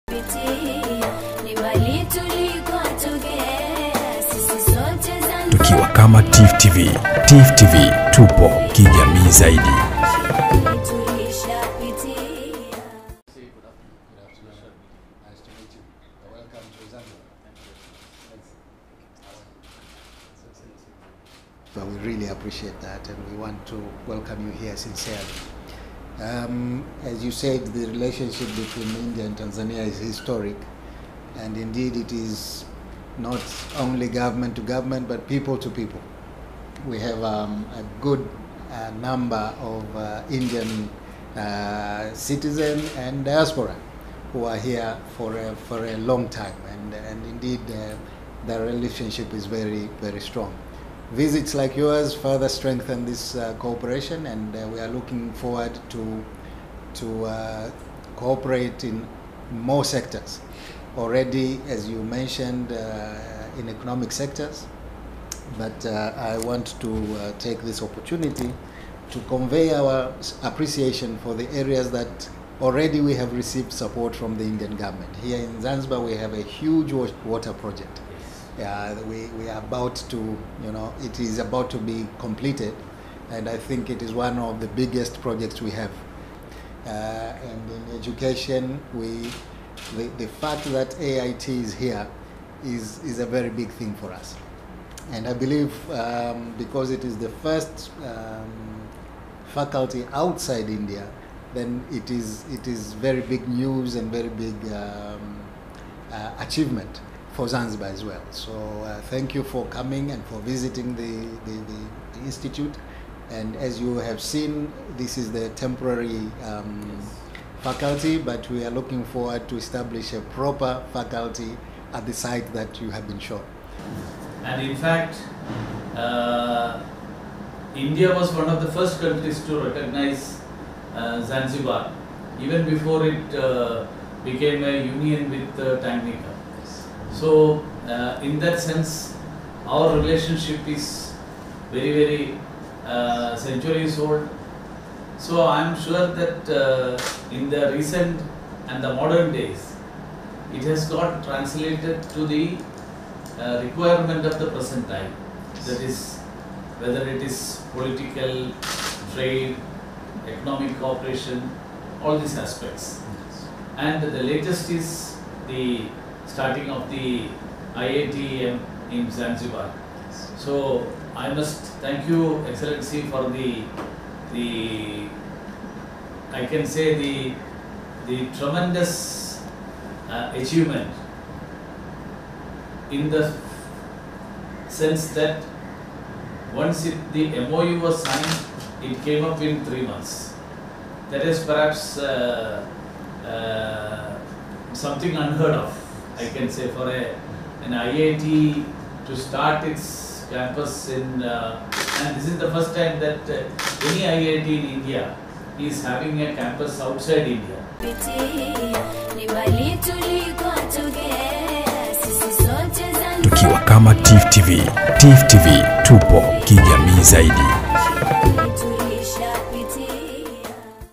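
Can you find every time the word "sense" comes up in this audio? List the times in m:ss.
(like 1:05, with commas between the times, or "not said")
2:18, 3:04.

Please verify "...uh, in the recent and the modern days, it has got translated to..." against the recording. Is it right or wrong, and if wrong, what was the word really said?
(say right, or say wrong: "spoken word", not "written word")
right.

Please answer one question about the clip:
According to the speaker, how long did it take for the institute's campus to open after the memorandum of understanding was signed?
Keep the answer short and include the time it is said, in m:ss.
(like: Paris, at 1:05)
3 months, at 3:09.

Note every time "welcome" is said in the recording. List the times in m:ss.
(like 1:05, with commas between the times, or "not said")
0:24.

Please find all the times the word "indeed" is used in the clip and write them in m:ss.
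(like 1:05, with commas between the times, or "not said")
0:31, 0:47.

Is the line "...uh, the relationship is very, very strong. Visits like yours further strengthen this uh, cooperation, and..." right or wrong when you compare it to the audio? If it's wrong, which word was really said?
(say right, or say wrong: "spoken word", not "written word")
right.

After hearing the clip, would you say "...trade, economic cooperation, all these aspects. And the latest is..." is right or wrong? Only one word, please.
right.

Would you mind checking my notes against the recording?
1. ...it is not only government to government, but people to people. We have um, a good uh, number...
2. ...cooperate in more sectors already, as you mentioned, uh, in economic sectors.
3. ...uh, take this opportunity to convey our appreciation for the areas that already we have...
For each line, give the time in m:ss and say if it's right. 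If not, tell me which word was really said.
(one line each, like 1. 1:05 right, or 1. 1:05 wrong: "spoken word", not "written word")
1. 0:31 right
2. 0:58 right
3. 1:07 right.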